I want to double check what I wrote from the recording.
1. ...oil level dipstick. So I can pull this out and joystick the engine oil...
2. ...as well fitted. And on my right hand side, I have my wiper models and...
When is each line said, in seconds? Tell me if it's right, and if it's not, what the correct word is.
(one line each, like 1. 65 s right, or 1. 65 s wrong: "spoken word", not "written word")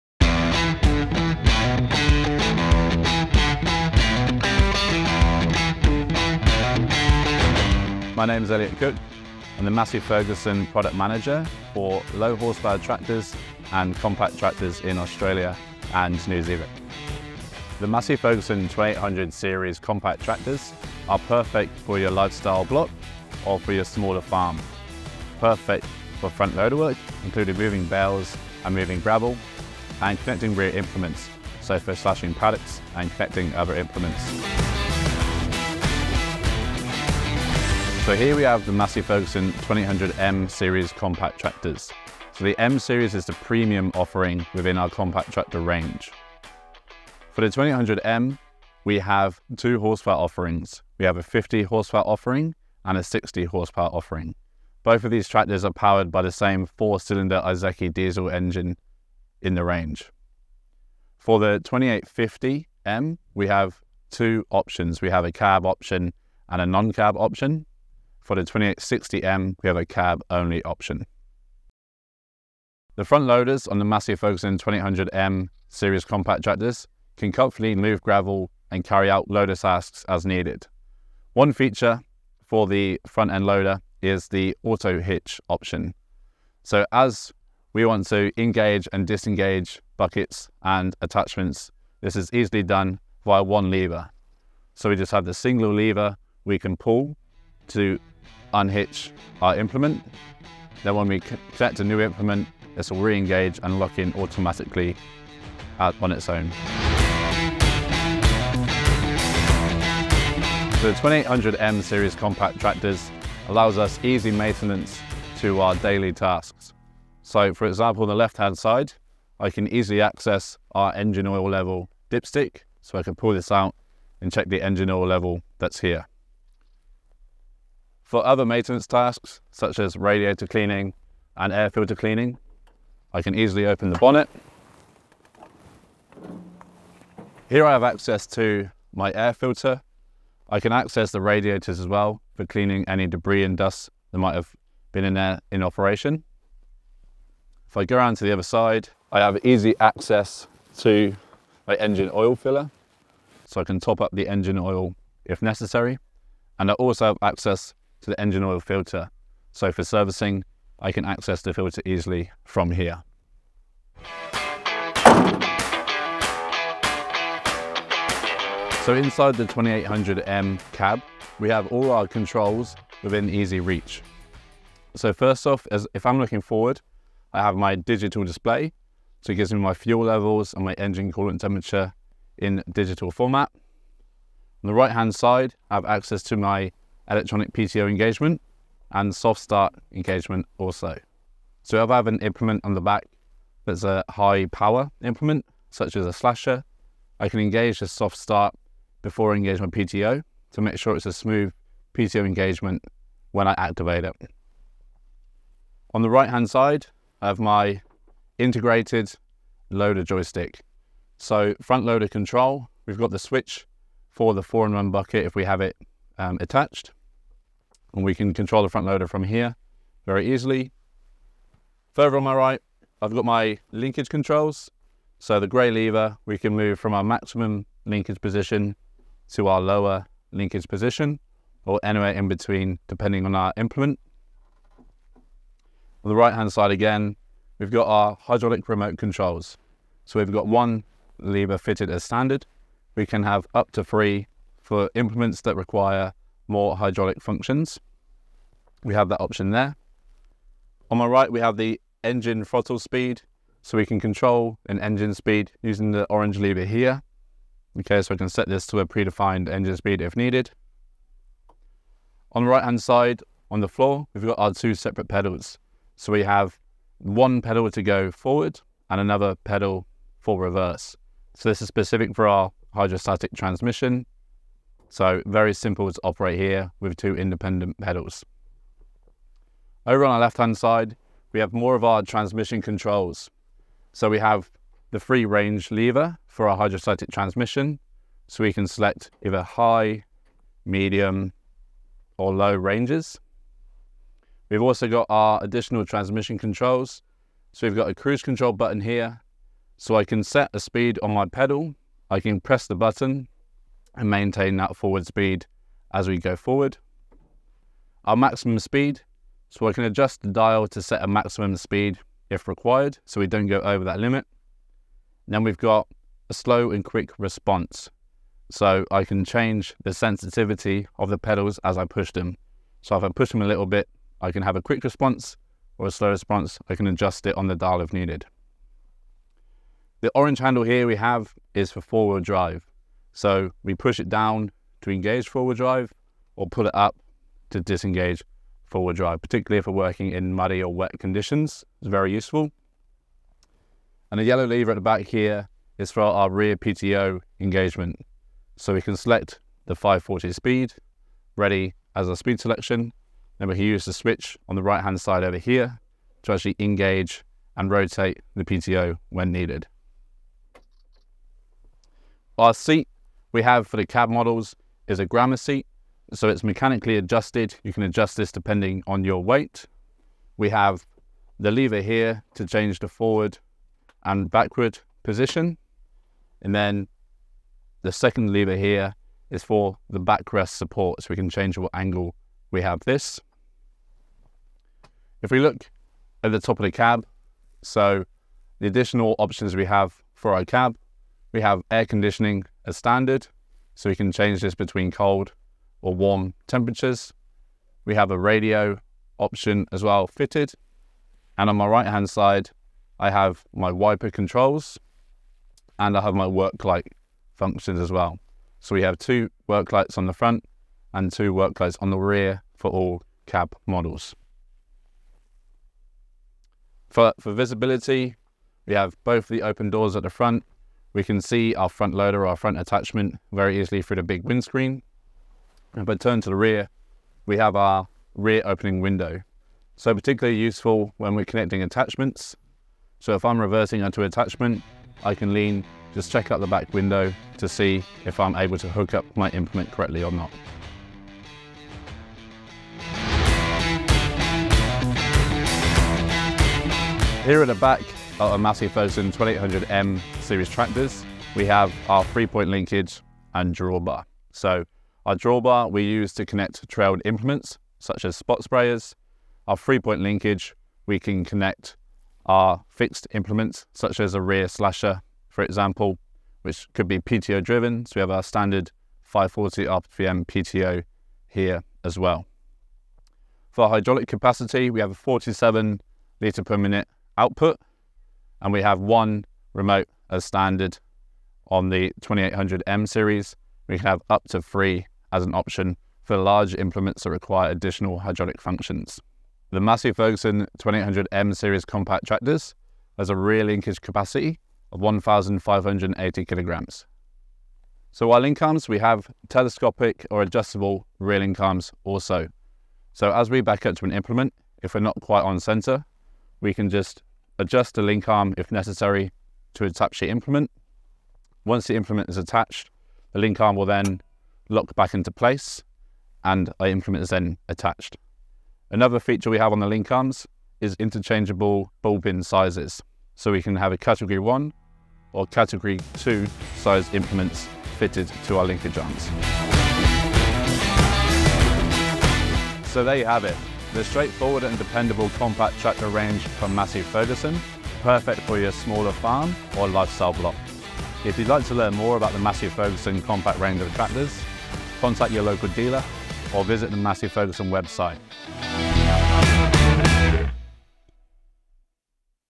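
1. 121 s wrong: "check", not "joystick"
2. 399 s wrong: "controls", not "models".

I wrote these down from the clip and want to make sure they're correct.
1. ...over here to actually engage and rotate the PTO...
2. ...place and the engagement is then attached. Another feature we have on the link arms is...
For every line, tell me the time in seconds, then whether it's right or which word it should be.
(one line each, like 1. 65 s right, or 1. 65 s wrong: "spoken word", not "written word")
1. 355 s right
2. 515 s wrong: "implement", not "engagement".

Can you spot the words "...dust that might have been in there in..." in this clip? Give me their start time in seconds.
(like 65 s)
143 s.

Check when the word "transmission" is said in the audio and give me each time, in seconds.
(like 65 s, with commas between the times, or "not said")
273 s, 282 s, 287 s, 295 s.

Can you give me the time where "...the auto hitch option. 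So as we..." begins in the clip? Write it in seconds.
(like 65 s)
84 s.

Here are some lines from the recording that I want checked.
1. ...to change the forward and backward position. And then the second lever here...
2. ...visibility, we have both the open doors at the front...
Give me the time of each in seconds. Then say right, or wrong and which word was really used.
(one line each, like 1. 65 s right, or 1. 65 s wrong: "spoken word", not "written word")
1. 372 s right
2. 417 s right.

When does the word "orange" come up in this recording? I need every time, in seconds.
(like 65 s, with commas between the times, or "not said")
256 s, 330 s.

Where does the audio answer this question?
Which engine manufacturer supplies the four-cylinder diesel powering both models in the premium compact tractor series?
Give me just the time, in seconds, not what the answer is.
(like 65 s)
57 s.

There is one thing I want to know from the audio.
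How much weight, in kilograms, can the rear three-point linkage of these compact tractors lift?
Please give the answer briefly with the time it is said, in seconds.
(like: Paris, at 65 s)
1,580 kg, at 494 s.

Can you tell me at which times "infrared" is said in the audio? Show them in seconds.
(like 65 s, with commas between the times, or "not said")
not said.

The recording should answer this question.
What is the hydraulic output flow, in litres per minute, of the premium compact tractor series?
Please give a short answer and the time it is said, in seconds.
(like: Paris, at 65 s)
47 litres per minute, at 474 s.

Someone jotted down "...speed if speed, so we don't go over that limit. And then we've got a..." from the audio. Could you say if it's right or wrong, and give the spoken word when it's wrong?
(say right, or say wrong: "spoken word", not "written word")
wrong: "required", not "speed".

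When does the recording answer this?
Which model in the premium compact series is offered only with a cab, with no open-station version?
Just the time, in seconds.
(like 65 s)
68 s.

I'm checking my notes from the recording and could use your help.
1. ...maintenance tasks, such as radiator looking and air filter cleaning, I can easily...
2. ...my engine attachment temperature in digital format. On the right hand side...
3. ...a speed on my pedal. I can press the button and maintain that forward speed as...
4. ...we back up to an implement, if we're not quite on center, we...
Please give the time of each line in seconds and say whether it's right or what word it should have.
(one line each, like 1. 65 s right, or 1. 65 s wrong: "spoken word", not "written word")
1. 128 s wrong: "cleaning", not "looking"
2. 180 s wrong: "coolant", not "attachment"
3. 300 s right
4. 503 s right.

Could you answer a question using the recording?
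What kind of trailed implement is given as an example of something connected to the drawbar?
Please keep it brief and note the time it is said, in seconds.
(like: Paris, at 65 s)
Spot sprayers, at 458 s.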